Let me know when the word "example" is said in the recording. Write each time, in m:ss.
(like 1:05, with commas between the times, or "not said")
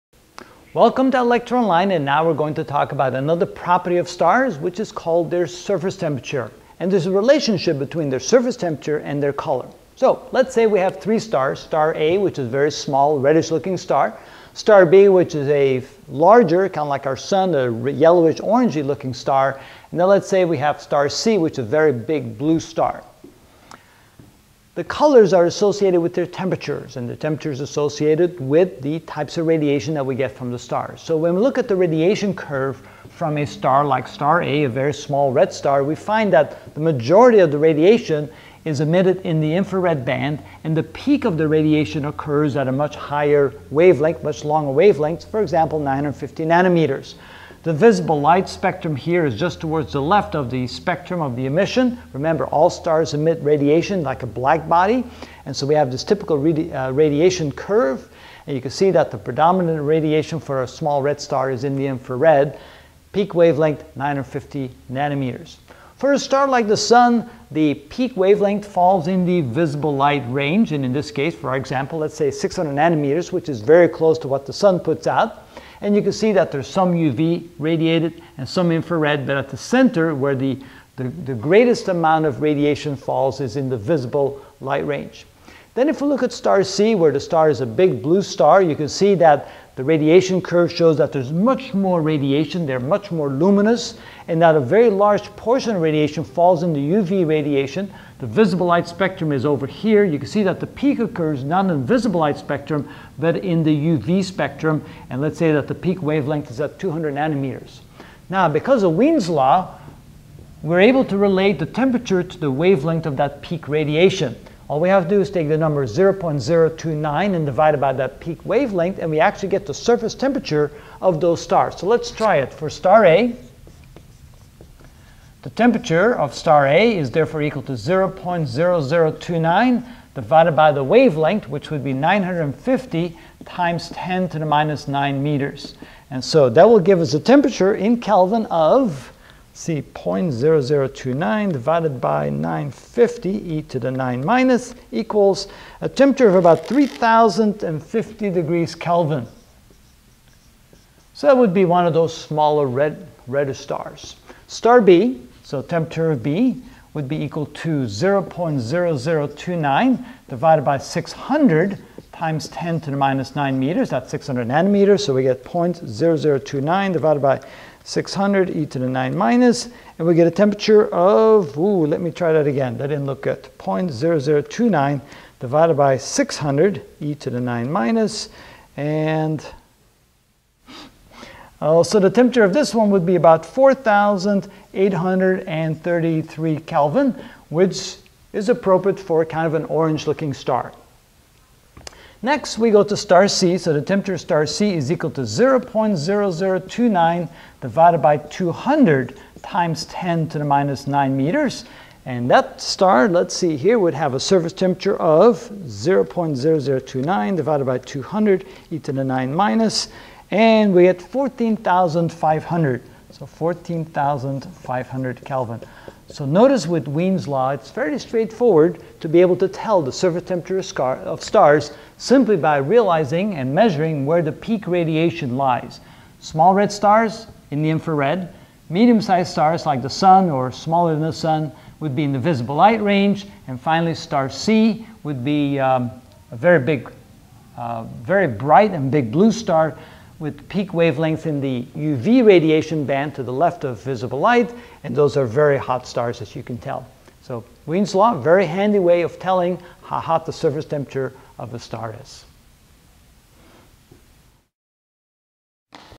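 0:45, 1:11.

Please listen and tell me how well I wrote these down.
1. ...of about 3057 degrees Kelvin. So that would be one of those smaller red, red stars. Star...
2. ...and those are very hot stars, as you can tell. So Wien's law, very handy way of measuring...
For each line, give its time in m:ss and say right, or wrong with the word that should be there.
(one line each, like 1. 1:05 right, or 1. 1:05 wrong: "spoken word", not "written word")
1. 2:26 wrong: "3050", not "3057"
2. 4:04 wrong: "telling", not "measuring".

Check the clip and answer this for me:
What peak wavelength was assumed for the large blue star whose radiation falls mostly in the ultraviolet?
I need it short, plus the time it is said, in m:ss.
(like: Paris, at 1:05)
200 nanometers, at 1:46.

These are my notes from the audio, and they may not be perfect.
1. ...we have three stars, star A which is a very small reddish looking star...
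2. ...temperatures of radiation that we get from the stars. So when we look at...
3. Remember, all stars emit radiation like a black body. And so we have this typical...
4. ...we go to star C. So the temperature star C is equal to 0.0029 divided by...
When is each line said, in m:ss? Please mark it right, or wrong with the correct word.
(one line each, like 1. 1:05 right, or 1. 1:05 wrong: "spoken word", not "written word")
1. 0:10 right
2. 0:28 wrong: "types", not "temperatures"
3. 0:52 right
4. 3:12 right.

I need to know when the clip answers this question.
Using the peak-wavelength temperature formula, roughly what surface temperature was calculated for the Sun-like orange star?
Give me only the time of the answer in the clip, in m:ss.
3:03.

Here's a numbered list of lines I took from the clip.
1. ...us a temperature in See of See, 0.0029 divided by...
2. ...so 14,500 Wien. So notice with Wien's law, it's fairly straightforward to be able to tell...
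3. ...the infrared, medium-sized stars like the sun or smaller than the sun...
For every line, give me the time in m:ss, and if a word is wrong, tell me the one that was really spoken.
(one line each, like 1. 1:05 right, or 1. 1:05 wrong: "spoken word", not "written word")
1. 2:17 wrong: "Kelvin", not "See"
2. 3:33 wrong: "Kelvin", not "Wien"
3. 3:47 right.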